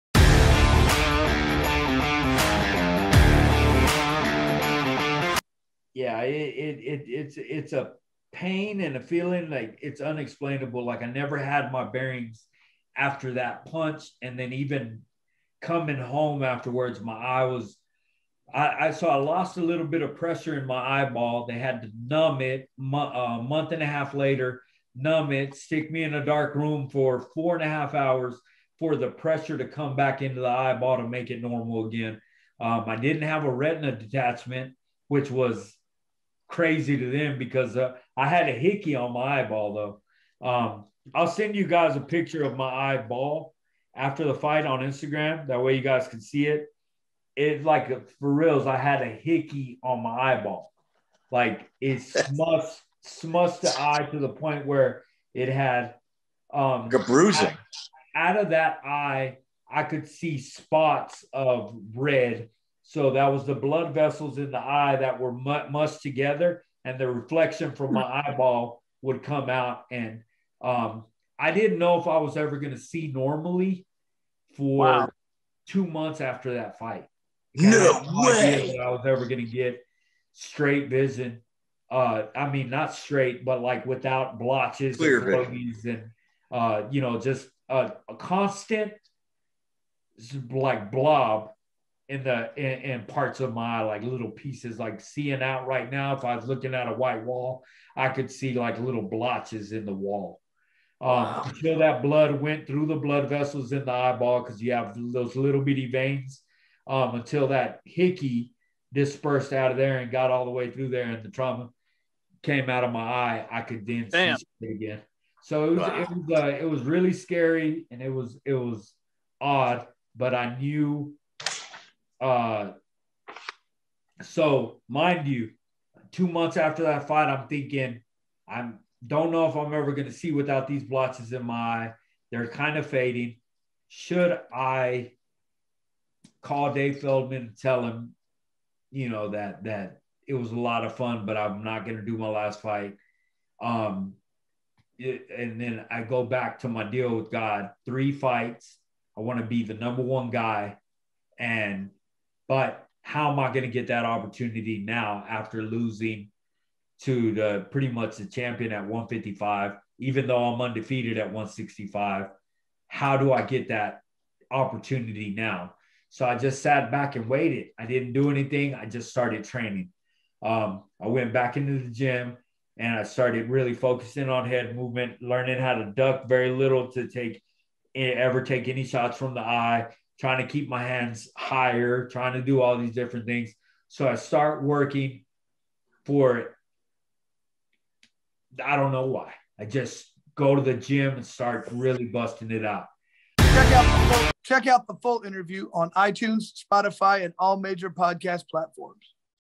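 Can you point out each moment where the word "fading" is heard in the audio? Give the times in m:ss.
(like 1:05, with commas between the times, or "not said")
2:12.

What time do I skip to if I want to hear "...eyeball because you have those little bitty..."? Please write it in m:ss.
1:43.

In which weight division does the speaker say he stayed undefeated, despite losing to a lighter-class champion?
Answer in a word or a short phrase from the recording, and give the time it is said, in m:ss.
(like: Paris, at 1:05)
165, at 2:41.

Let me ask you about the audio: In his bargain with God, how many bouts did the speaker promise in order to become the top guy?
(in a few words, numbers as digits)
3.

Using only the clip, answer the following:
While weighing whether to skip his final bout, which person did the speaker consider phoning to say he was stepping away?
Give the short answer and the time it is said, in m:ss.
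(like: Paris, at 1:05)
Dave Feldman, at 2:16.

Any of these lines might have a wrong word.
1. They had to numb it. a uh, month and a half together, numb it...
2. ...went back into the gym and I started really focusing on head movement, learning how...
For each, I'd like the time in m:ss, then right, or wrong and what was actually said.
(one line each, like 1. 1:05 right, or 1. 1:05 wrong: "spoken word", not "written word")
1. 0:21 wrong: "later", not "together"
2. 2:51 right.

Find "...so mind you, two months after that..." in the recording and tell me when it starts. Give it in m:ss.
2:04.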